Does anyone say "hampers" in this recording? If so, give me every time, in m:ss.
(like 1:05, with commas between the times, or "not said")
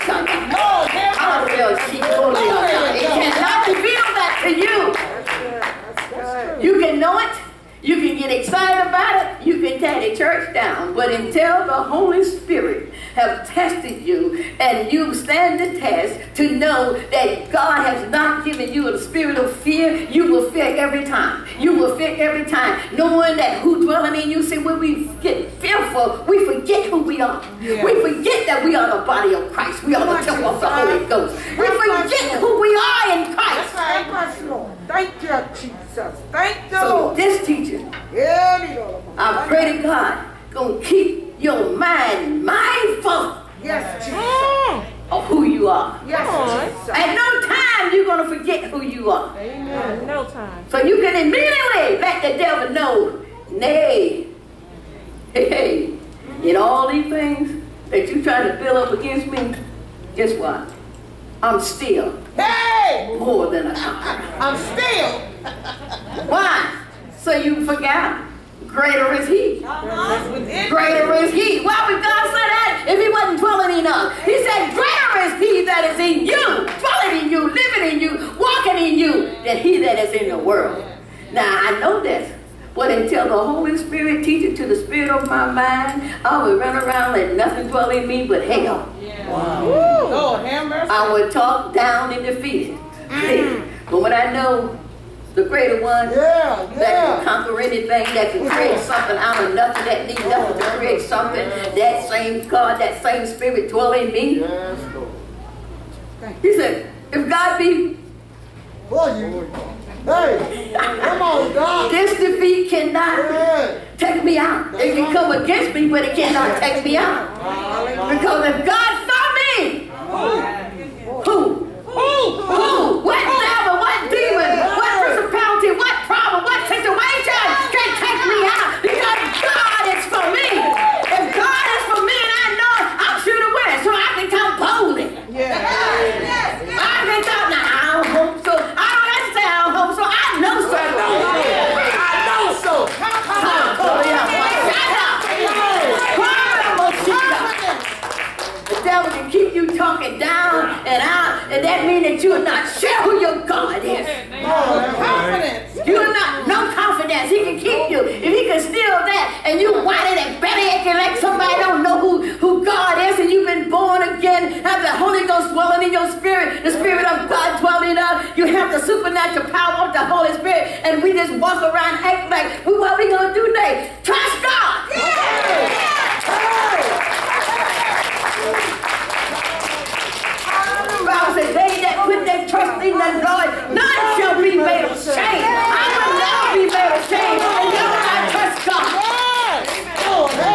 0:01.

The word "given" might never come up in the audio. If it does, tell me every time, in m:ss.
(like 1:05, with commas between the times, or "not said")
0:18.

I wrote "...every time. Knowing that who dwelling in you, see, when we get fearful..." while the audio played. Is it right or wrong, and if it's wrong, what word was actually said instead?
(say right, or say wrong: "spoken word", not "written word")
right.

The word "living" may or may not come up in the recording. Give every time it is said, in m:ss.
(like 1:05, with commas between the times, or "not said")
1:17.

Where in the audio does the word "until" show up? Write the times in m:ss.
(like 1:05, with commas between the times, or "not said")
0:11, 1:22.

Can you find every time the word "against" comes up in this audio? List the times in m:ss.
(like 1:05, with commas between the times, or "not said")
0:58, 1:55.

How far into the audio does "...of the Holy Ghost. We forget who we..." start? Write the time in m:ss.
0:30.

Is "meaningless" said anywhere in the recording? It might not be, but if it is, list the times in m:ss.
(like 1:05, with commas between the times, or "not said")
not said.